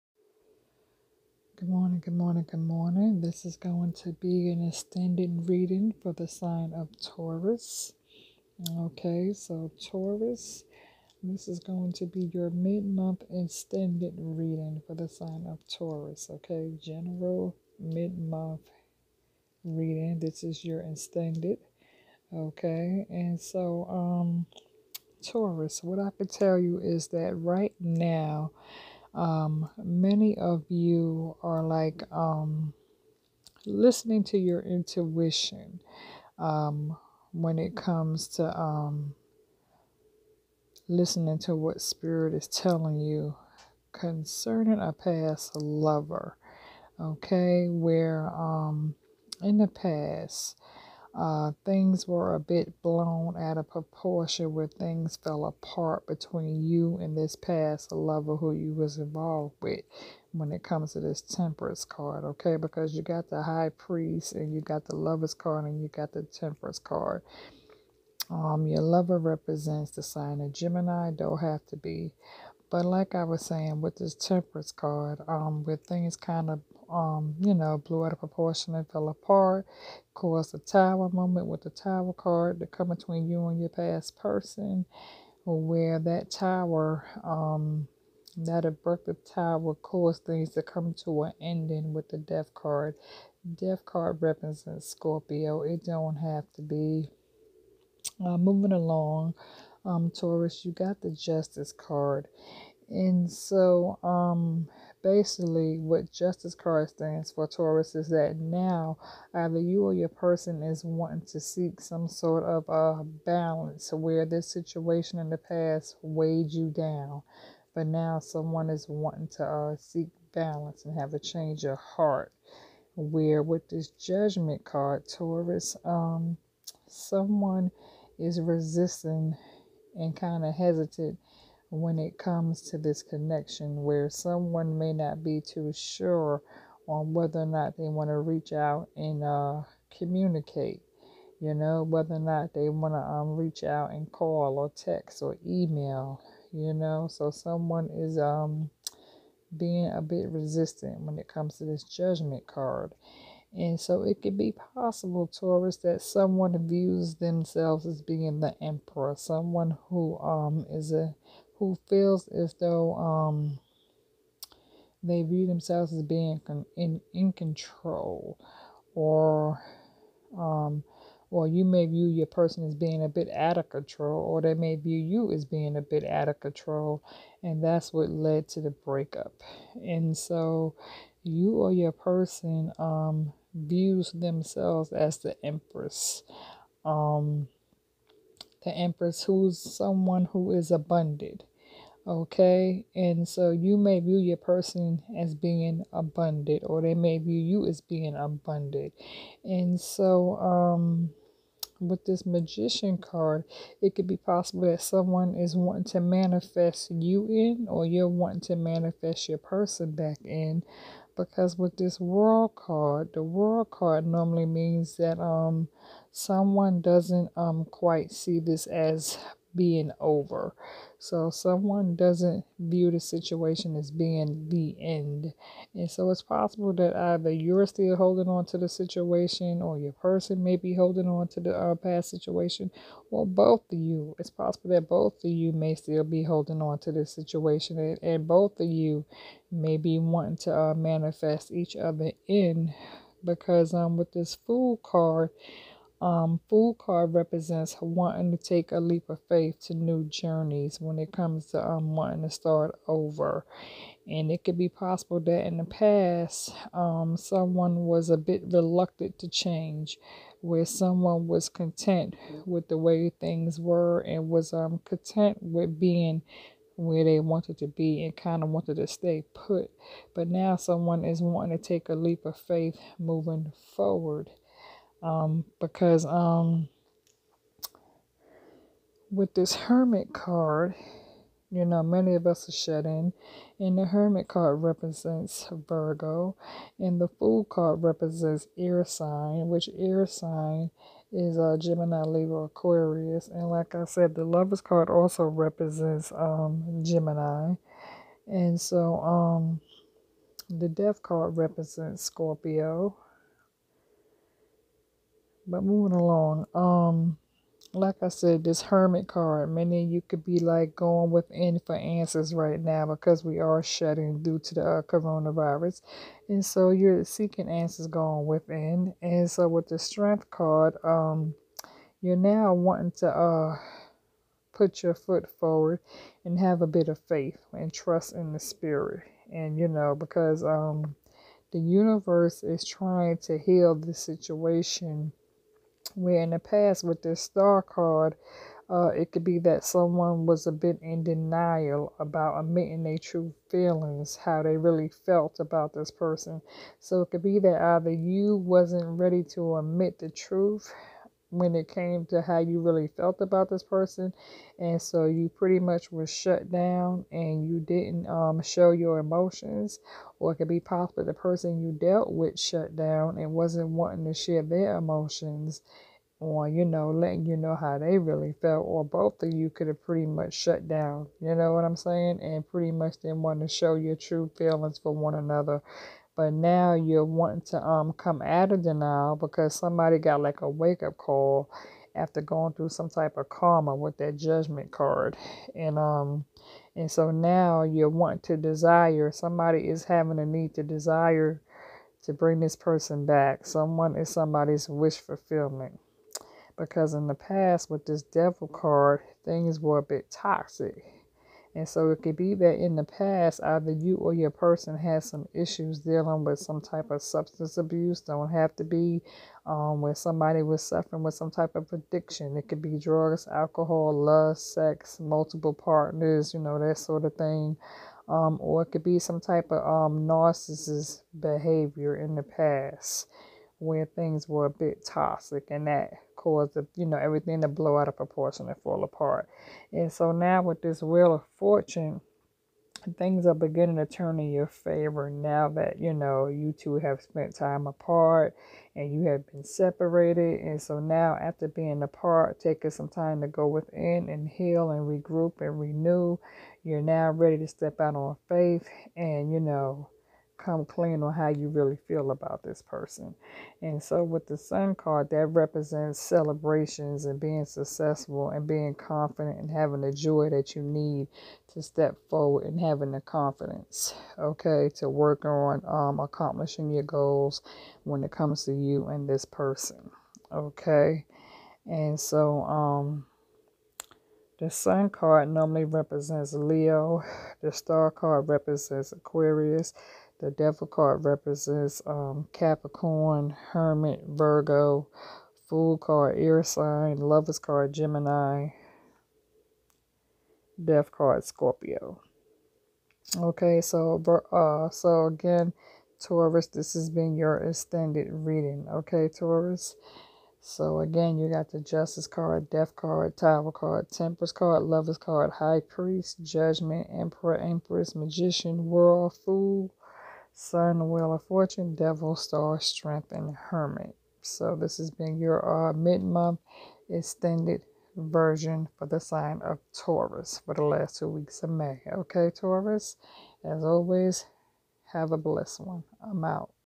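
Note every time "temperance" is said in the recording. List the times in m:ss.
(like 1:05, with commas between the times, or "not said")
1:01, 1:06, 1:14, 8:23.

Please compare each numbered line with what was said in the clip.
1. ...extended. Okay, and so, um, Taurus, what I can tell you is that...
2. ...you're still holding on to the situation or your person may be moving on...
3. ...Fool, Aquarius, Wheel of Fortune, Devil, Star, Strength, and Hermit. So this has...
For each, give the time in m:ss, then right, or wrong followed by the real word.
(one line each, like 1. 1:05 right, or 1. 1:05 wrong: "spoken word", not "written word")
1. 0:20 right
2. 3:47 wrong: "holding", not "moving"
3. 8:29 wrong: "Sun", not "Aquarius".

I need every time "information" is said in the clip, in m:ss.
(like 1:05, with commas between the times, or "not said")
not said.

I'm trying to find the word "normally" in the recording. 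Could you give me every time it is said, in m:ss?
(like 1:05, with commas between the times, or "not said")
3:34, 7:55.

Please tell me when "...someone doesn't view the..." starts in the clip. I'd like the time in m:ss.
3:41.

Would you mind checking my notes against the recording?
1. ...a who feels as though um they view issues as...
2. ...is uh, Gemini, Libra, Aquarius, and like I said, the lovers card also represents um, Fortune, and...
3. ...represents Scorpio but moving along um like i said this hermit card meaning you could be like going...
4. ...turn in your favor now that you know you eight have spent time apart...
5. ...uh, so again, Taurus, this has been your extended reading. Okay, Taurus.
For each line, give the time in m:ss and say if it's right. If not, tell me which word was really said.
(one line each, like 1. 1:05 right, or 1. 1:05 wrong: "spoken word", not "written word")
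1. 2:40 wrong: "themselves", not "issues"
2. 4:51 wrong: "Gemini", not "Fortune"
3. 5:01 right
4. 7:13 wrong: "two", not "eight"
5. 8:14 right.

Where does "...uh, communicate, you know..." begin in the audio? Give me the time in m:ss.
2:19.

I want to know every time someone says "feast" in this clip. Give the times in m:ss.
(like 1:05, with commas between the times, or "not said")
not said.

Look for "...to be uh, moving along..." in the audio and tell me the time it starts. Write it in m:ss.
1:36.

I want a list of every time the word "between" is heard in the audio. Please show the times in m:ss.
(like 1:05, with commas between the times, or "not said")
0:56, 1:22.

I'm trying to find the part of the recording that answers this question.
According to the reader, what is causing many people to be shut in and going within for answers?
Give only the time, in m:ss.
5:14.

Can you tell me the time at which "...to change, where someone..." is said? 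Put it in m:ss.
4:19.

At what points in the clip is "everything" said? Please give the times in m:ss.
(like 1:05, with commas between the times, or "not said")
7:06.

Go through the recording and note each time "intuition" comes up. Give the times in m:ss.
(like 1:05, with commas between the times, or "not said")
0:34.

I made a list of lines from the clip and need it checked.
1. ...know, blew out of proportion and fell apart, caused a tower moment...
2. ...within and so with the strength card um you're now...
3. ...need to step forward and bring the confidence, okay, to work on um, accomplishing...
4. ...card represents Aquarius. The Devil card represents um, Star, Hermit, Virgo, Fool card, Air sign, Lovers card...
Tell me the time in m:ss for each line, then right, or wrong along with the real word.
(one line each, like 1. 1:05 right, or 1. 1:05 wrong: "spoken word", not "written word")
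1. 1:17 right
2. 5:18 right
3. 7:40 wrong: "having", not "bring"
4. 7:57 wrong: "Capricorn", not "Star".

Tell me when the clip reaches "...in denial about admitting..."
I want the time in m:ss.
5:40.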